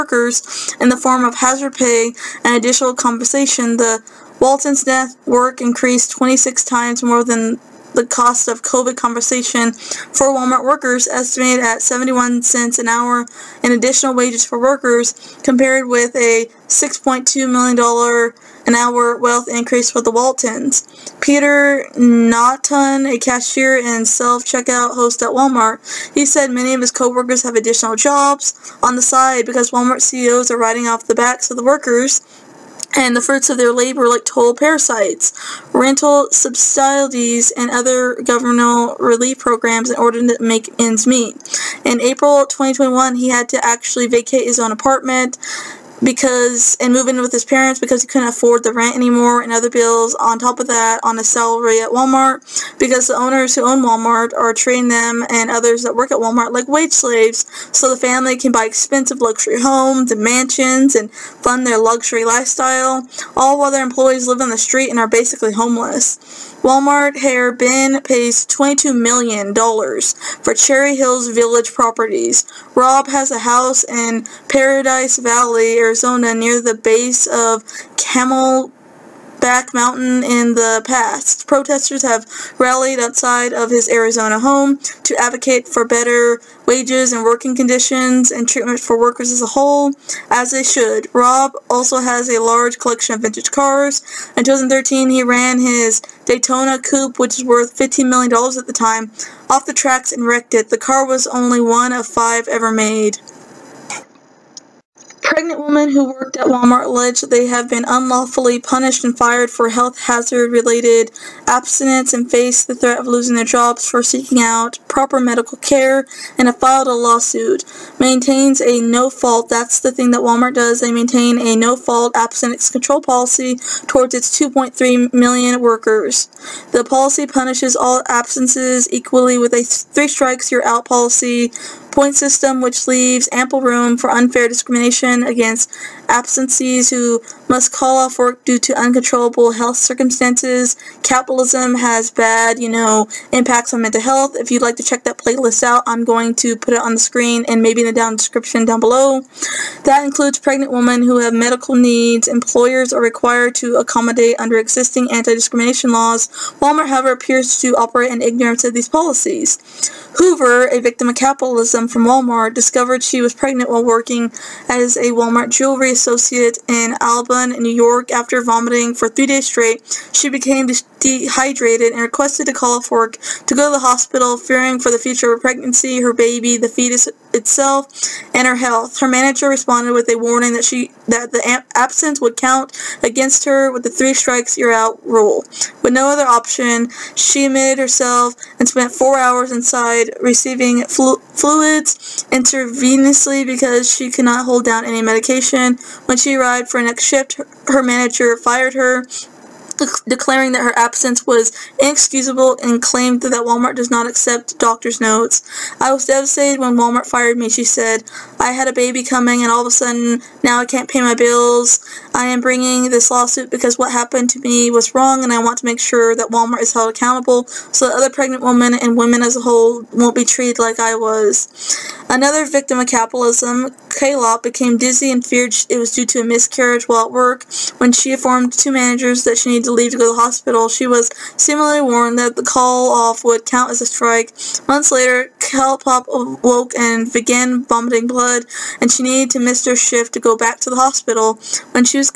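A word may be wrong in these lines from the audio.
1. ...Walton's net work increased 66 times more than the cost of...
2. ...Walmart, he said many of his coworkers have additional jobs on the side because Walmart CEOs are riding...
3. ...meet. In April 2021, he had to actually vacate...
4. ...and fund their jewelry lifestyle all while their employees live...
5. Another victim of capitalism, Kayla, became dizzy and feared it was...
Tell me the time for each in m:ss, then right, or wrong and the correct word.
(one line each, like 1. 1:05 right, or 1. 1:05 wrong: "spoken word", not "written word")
1. 0:04 wrong: "26", not "66"
2. 0:25 right
3. 0:41 right
4. 1:00 wrong: "luxury", not "jewelry"
5. 3:42 right.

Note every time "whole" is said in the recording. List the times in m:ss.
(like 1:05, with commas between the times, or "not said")
1:29, 3:39.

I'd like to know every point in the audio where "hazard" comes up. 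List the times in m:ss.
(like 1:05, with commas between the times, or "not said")
0:01, 1:50.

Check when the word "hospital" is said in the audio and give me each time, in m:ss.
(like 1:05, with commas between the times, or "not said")
2:53, 3:50, 4:00.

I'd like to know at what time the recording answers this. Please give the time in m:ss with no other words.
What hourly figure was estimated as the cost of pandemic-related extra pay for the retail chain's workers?
0:11.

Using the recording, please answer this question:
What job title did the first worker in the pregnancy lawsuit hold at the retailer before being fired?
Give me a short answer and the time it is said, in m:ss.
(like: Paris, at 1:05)
jewelry associate, at 2:45.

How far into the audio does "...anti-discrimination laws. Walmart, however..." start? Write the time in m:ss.
2:35.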